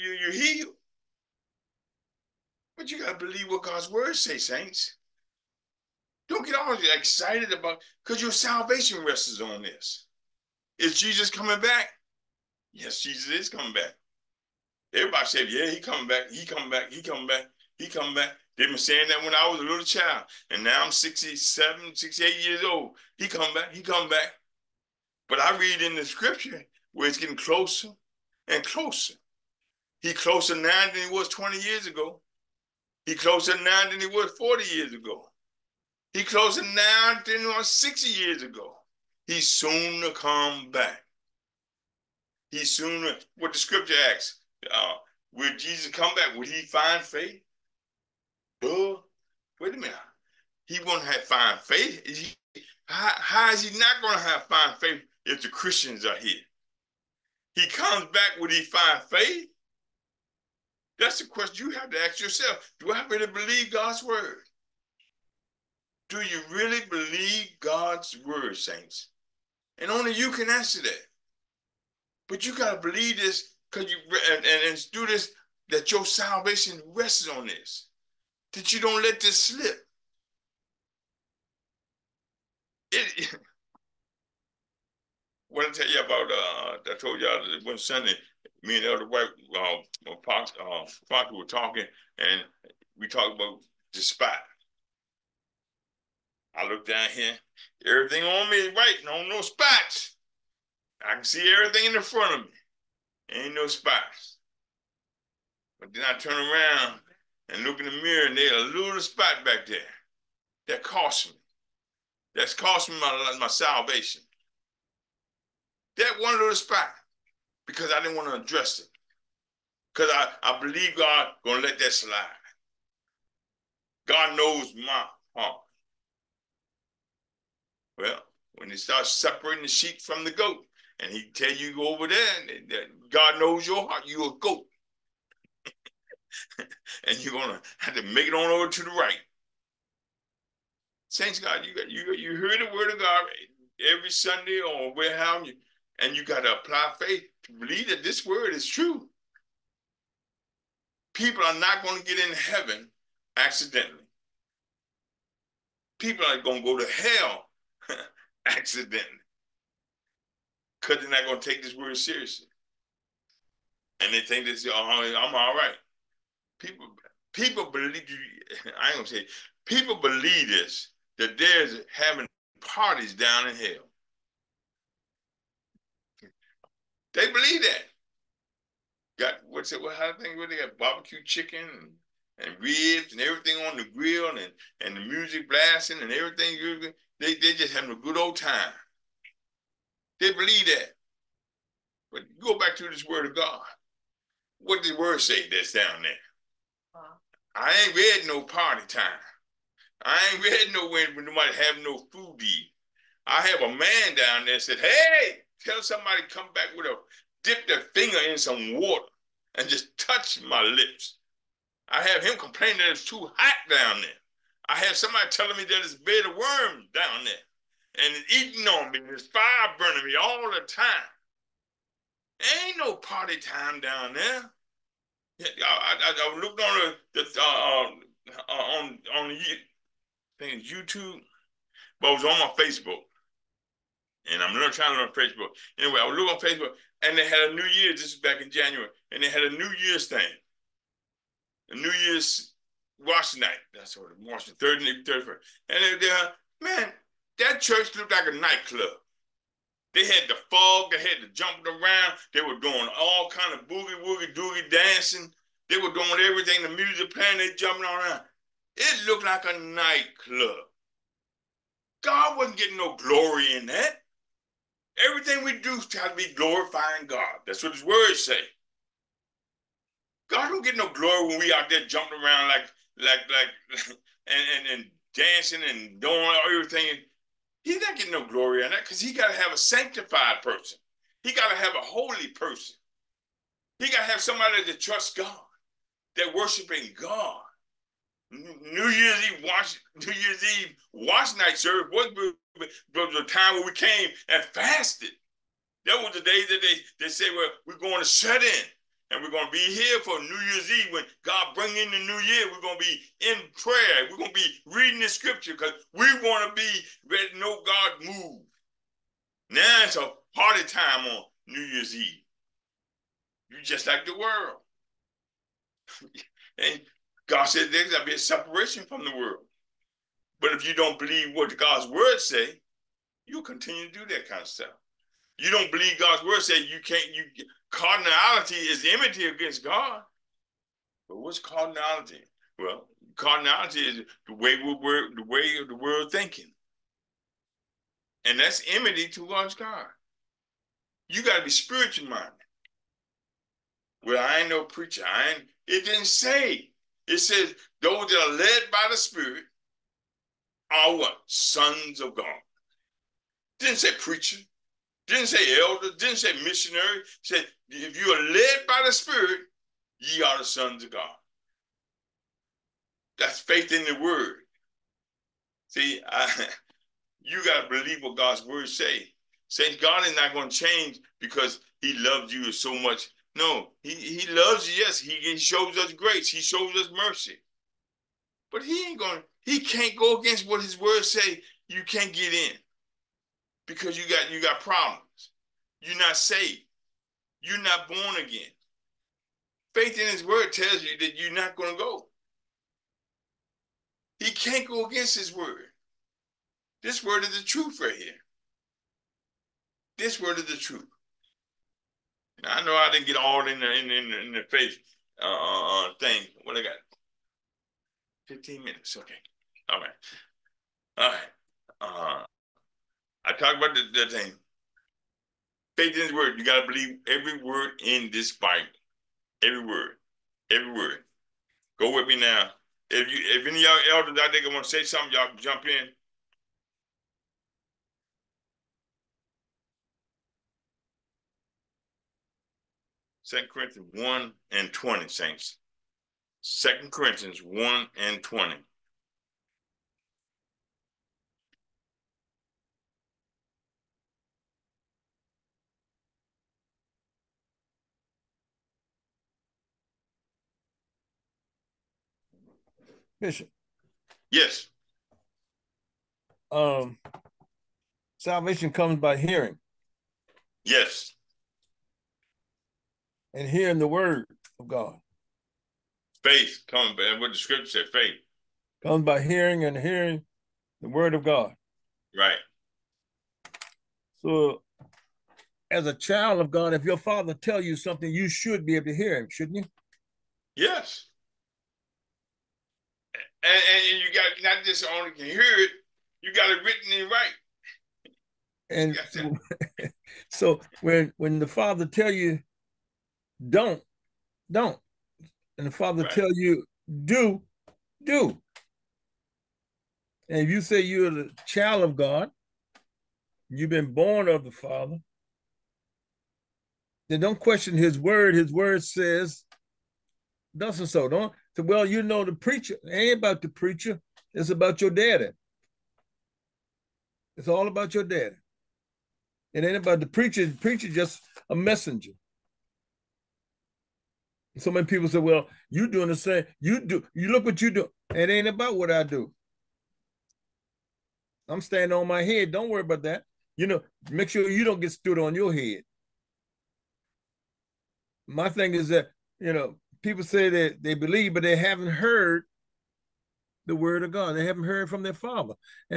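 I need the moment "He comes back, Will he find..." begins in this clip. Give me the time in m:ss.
0:57.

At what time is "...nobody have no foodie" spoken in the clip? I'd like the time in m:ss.
3:21.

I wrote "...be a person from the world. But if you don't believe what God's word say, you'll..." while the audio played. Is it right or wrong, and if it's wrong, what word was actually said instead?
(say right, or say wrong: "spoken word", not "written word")
wrong: "separation", not "person".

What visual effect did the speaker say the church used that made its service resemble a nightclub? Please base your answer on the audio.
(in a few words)
fog.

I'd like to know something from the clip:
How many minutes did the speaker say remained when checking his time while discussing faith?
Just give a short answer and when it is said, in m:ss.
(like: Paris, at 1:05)
15, at 6:48.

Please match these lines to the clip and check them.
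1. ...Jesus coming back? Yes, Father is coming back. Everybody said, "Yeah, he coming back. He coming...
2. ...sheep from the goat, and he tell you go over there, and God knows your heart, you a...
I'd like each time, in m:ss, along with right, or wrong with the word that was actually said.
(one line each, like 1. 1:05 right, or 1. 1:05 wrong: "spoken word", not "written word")
1. 0:10 wrong: "Jesus", not "Father"
2. 2:09 right.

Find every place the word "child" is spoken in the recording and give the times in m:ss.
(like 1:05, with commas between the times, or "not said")
0:19, 7:55, 8:21.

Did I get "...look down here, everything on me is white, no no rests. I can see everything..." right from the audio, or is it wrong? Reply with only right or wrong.
wrong.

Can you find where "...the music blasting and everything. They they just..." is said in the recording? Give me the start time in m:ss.
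3:04.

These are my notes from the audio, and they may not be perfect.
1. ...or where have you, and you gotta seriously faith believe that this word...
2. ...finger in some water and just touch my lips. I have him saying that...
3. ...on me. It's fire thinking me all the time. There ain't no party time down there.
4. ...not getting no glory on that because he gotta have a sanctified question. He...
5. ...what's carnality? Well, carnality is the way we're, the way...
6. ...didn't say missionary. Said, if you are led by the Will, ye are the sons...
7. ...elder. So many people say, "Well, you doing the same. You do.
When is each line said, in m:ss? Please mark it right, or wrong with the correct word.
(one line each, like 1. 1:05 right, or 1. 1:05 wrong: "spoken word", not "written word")
1. 2:24 wrong: "apply", not "seriously"
2. 3:27 wrong: "complaining", not "saying"
3. 3:38 wrong: "burning", not "thinking"
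4. 4:37 wrong: "person", not "question"
5. 5:31 right
6. 5:55 wrong: "Spirit", not "Will"
7. 8:41 wrong: "messenger", not "elder".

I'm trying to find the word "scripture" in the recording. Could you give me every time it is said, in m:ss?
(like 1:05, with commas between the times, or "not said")
0:26, 0:43, 5:05, 7:47.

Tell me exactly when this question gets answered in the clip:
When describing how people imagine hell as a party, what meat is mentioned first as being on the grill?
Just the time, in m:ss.
3:00.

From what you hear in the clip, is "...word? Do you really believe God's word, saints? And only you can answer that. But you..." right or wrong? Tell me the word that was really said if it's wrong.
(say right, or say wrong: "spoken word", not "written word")
right.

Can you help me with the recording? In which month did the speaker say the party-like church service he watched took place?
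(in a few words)
January.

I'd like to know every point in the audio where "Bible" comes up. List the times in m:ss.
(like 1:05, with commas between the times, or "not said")
6:58.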